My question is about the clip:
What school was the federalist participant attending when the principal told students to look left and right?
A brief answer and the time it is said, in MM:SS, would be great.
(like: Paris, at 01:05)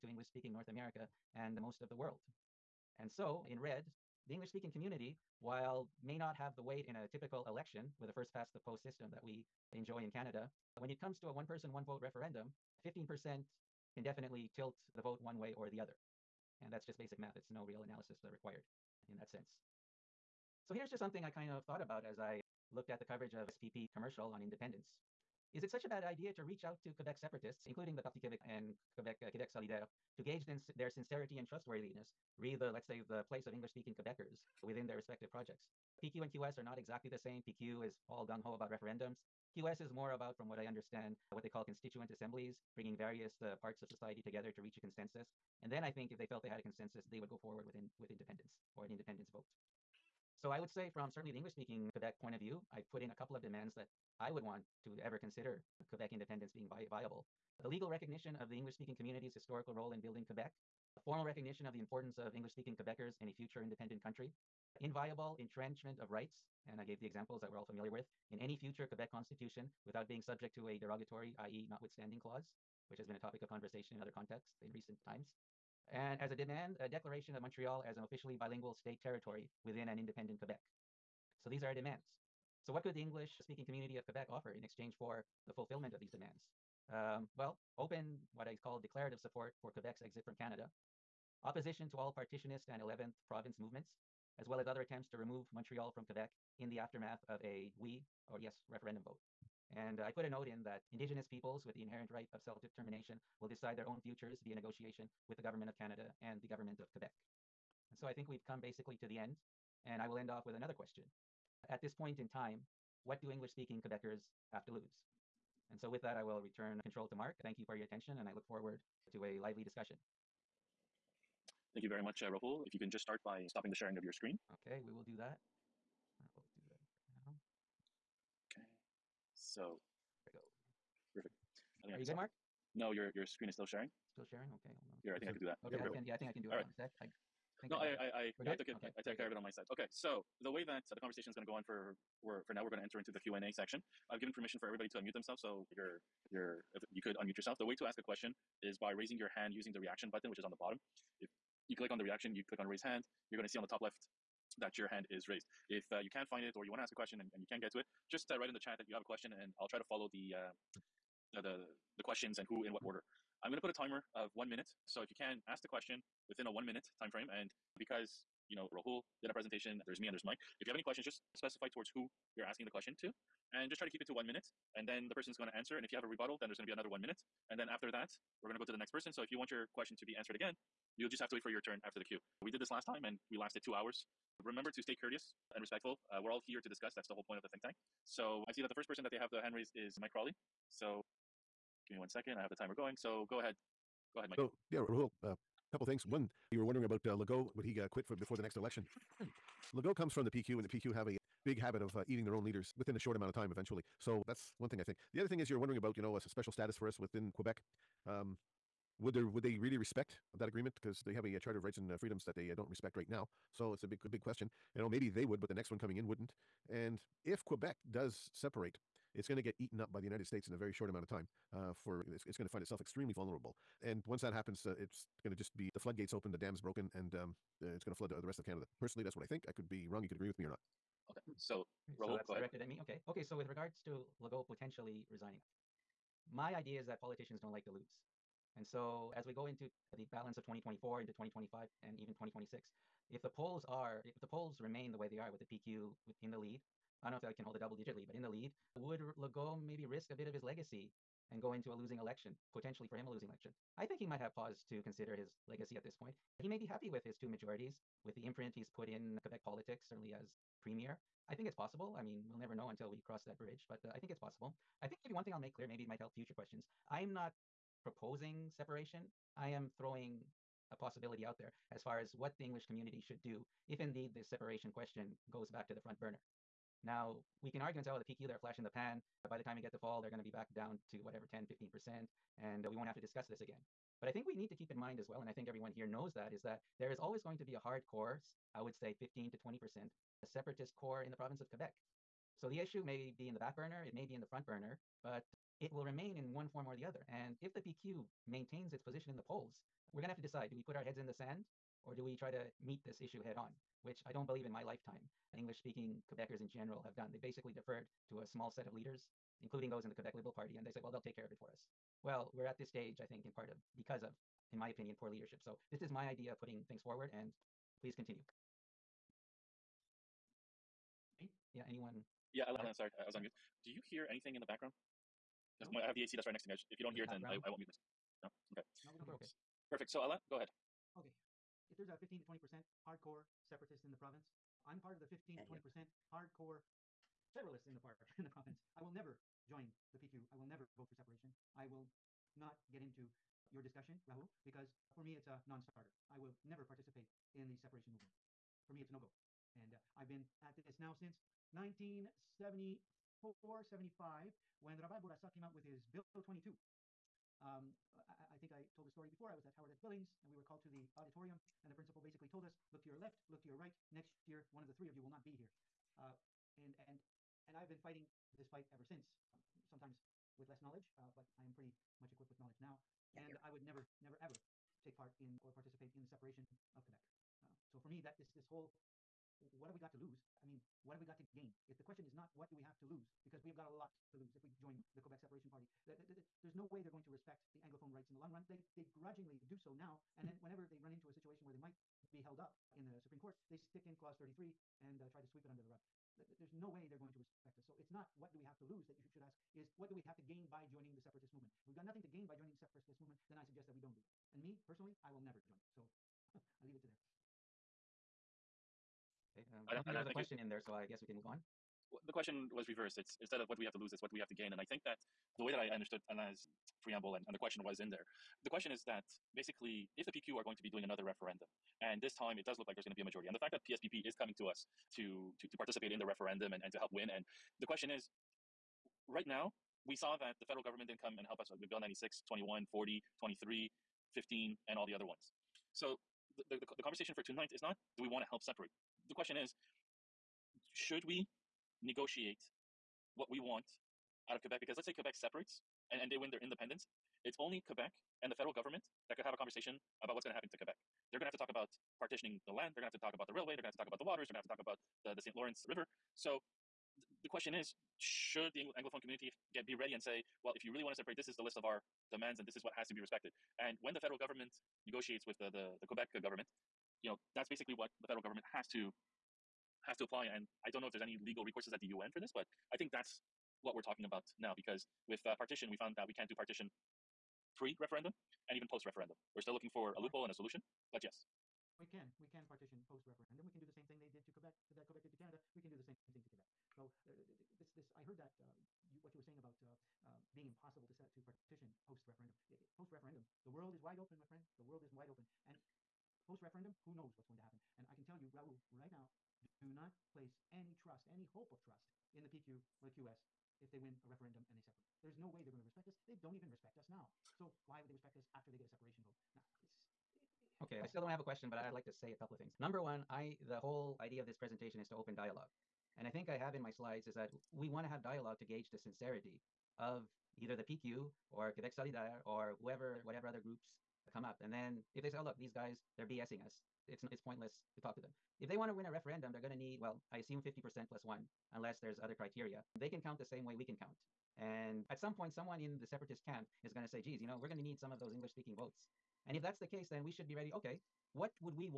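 Howard S. Billings, at 05:59.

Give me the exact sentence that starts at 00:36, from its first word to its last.
PQ and QS are not exactly the same.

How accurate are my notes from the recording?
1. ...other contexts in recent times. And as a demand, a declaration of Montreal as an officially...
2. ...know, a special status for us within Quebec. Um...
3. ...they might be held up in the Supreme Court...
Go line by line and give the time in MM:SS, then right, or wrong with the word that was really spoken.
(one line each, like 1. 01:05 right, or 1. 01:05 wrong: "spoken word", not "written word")
1. 01:14 right
2. 03:26 right
3. 06:31 right.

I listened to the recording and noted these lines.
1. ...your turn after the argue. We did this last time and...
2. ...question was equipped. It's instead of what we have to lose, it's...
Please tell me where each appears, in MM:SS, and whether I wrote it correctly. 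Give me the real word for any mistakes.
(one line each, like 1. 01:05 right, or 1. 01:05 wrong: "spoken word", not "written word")
1. 03:01 wrong: "queue", not "argue"
2. 06:52 wrong: "reversed", not "equipped".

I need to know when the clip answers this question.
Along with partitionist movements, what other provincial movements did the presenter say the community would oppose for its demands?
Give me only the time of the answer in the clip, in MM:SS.
01:32.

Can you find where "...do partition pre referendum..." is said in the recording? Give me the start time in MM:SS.
07:56.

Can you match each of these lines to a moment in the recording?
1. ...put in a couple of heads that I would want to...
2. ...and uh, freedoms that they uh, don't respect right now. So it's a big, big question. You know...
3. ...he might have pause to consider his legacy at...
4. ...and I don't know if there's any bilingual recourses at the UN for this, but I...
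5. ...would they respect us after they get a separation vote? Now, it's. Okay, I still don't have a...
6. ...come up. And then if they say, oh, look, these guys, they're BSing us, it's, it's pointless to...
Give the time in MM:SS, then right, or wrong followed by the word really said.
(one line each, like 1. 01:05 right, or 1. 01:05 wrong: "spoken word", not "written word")
1. 00:52 wrong: "demands", not "heads"
2. 03:31 right
3. 04:13 right
4. 07:50 wrong: "legal", not "bilingual"
5. 08:27 right
6. 08:44 right.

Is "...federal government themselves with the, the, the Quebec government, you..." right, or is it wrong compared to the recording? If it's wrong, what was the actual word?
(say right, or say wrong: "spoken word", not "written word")
wrong: "negotiates", not "themselves".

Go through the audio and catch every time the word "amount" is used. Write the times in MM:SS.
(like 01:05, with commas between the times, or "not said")
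03:23, 03:40.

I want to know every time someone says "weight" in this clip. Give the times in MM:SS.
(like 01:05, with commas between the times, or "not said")
00:06.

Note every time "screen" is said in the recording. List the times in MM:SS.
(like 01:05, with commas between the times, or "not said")
02:04, 02:13.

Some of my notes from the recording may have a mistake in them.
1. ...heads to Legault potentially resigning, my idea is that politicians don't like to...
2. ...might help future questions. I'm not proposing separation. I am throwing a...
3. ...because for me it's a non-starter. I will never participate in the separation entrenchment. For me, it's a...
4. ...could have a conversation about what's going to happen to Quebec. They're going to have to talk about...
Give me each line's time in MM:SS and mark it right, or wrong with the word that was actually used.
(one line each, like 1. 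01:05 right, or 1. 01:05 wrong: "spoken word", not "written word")
1. 03:53 wrong: "regards", not "heads"
2. 04:25 right
3. 05:44 wrong: "movement", not "entrenchment"
4. 07:29 right.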